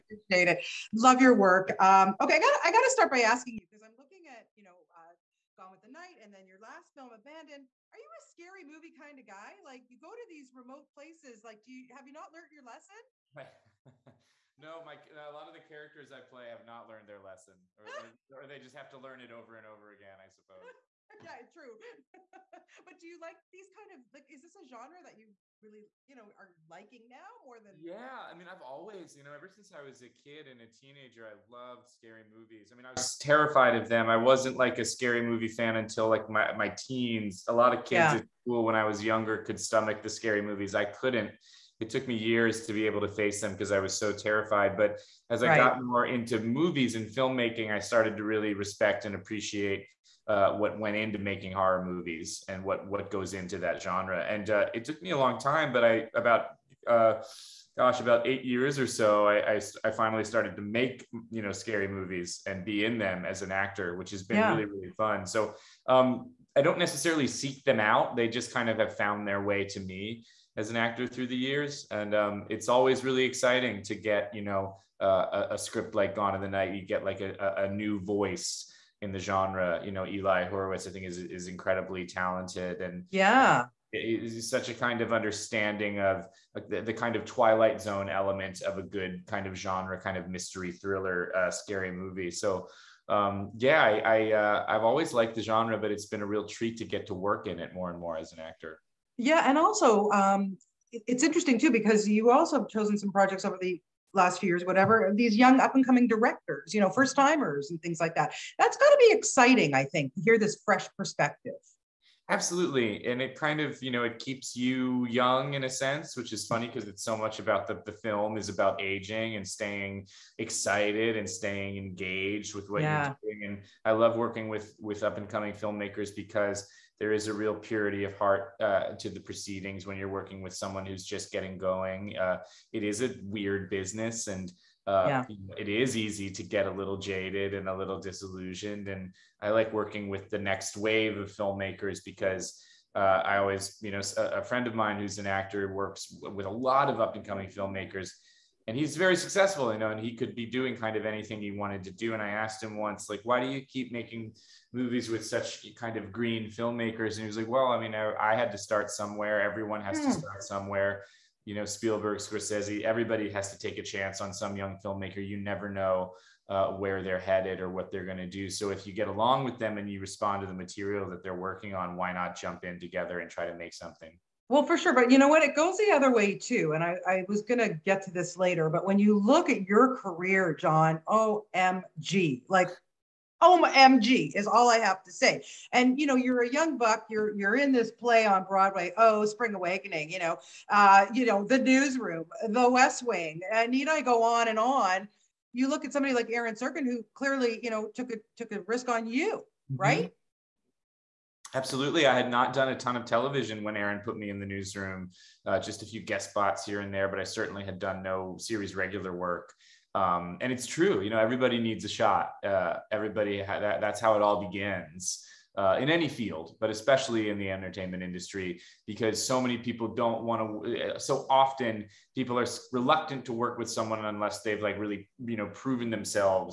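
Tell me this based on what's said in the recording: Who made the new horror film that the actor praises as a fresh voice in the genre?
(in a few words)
Eli Horowitz.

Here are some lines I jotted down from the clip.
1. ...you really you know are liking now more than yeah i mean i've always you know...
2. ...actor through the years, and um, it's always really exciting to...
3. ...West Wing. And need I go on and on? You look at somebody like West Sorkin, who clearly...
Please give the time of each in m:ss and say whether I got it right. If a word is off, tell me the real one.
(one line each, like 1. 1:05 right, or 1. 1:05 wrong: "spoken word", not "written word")
1. 0:25 right
2. 1:10 right
3. 3:12 wrong: "Aaron", not "West".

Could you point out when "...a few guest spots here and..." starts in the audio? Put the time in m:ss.
3:25.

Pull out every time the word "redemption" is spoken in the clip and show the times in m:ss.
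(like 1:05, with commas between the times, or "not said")
not said.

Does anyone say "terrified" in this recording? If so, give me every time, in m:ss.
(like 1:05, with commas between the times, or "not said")
0:33, 0:44.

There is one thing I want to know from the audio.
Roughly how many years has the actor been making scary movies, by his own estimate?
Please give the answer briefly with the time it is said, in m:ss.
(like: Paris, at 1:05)
8 years, at 0:58.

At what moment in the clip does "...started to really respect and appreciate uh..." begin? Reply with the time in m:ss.
0:47.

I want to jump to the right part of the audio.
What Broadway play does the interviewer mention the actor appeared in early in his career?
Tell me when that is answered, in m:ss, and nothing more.
3:09.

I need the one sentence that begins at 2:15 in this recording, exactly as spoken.
it is easy to get a little jaded and a little disillusioned.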